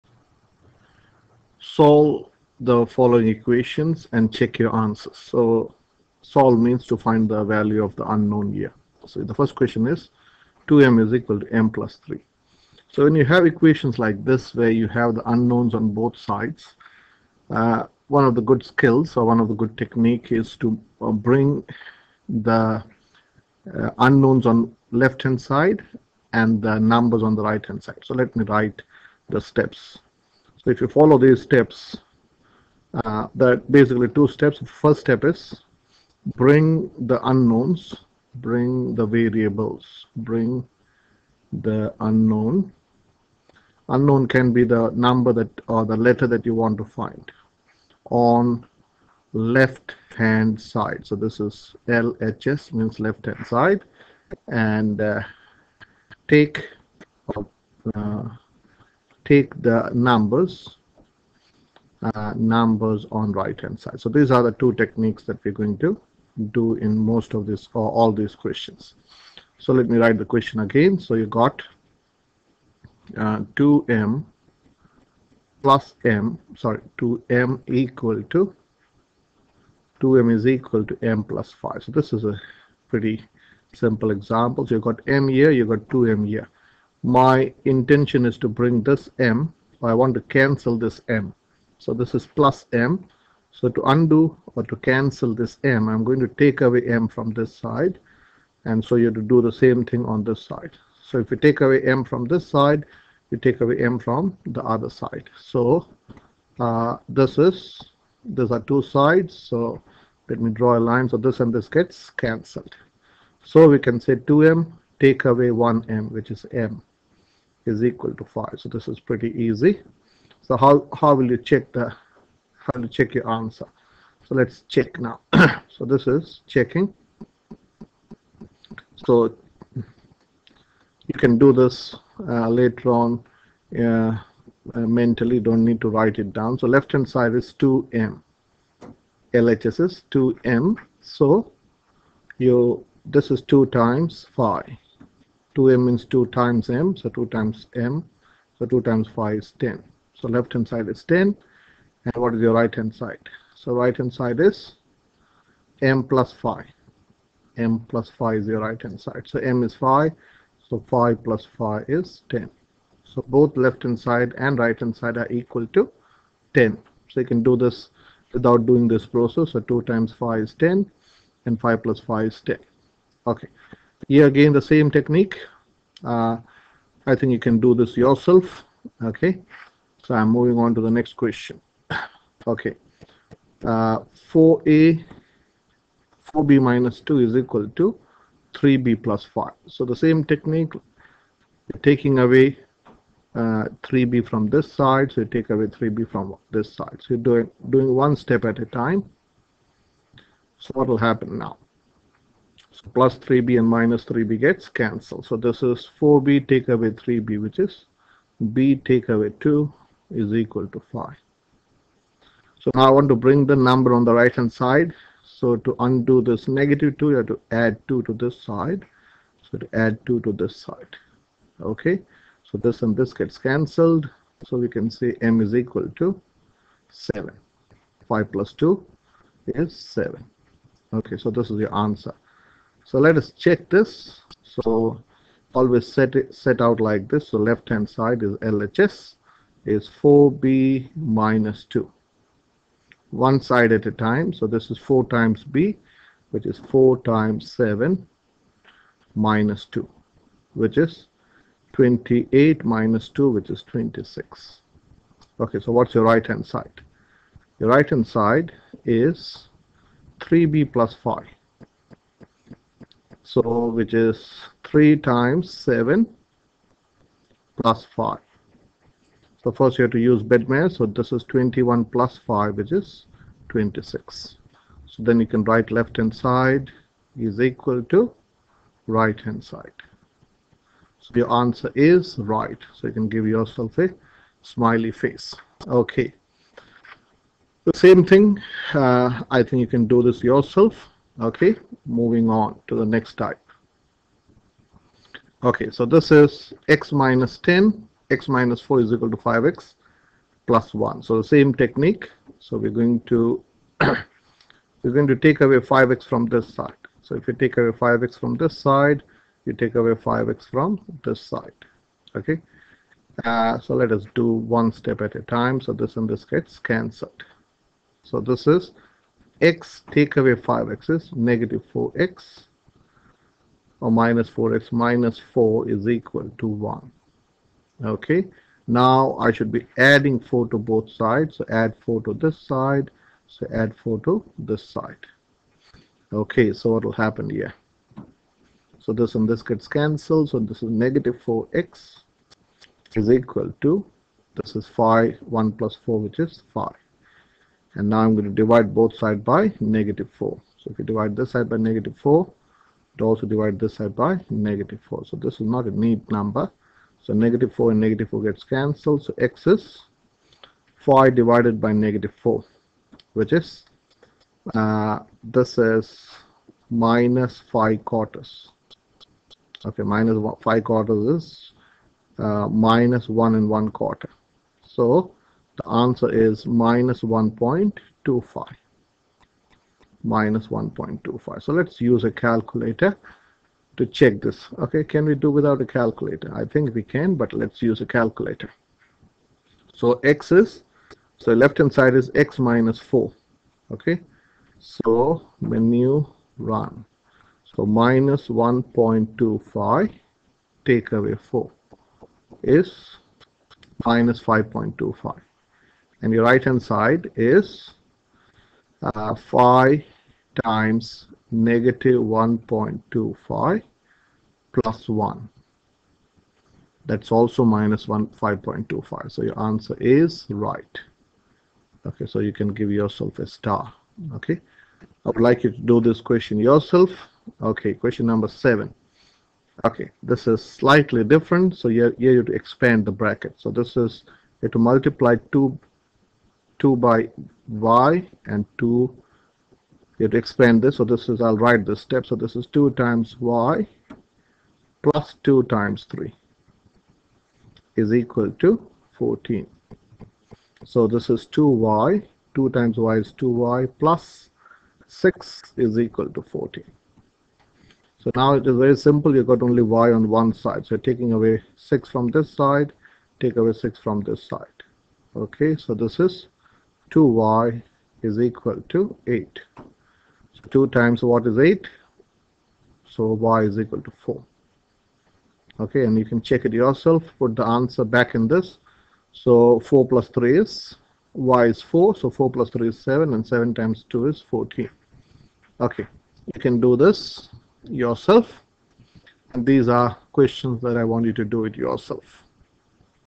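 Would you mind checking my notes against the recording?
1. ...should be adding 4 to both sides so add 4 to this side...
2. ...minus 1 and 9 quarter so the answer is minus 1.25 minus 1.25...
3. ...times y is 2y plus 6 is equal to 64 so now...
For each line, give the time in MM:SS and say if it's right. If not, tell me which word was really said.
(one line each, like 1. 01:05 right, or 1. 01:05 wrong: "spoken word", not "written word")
1. 05:29 right
2. 06:12 wrong: "1", not "9"
3. 07:32 wrong: "14", not "64".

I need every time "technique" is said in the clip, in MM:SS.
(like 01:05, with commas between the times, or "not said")
00:19, 01:04, 02:54, 03:10, 05:01.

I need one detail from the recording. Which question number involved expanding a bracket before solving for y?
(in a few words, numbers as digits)
7.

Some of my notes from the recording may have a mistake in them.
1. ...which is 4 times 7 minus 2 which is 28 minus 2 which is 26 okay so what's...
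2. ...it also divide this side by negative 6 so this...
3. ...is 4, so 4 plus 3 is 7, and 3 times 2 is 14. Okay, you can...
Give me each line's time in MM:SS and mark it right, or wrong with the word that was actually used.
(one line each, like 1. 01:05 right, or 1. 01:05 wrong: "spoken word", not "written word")
1. 04:06 right
2. 05:52 wrong: "4", not "6"
3. 08:01 wrong: "7", not "3".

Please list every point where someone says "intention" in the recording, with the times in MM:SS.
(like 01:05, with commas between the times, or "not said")
01:27.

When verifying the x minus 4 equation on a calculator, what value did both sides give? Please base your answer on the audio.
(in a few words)
-5.25.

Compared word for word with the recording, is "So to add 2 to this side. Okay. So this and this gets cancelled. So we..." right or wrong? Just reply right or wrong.
right.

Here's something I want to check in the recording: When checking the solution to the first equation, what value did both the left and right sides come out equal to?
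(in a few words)
10.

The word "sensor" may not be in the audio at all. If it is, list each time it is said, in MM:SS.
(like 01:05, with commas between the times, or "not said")
not said.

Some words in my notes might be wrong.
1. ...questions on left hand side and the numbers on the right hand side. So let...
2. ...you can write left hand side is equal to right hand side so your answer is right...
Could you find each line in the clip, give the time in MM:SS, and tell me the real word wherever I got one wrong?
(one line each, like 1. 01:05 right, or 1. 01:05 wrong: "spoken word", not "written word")
1. 00:23 wrong: "unknowns", not "questions"
2. 04:35 right.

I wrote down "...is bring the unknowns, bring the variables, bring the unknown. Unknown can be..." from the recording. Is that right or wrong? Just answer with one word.
right.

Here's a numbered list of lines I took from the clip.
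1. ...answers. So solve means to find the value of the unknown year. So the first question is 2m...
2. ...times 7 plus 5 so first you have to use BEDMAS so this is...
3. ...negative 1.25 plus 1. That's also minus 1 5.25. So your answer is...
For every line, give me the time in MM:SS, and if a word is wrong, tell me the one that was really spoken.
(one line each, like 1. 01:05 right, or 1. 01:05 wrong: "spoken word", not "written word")
1. 00:04 right
2. 04:24 right
3. 06:51 right.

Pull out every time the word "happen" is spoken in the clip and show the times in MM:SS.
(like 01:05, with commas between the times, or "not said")
03:20, 05:37.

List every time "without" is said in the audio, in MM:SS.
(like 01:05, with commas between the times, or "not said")
02:48, 06:25.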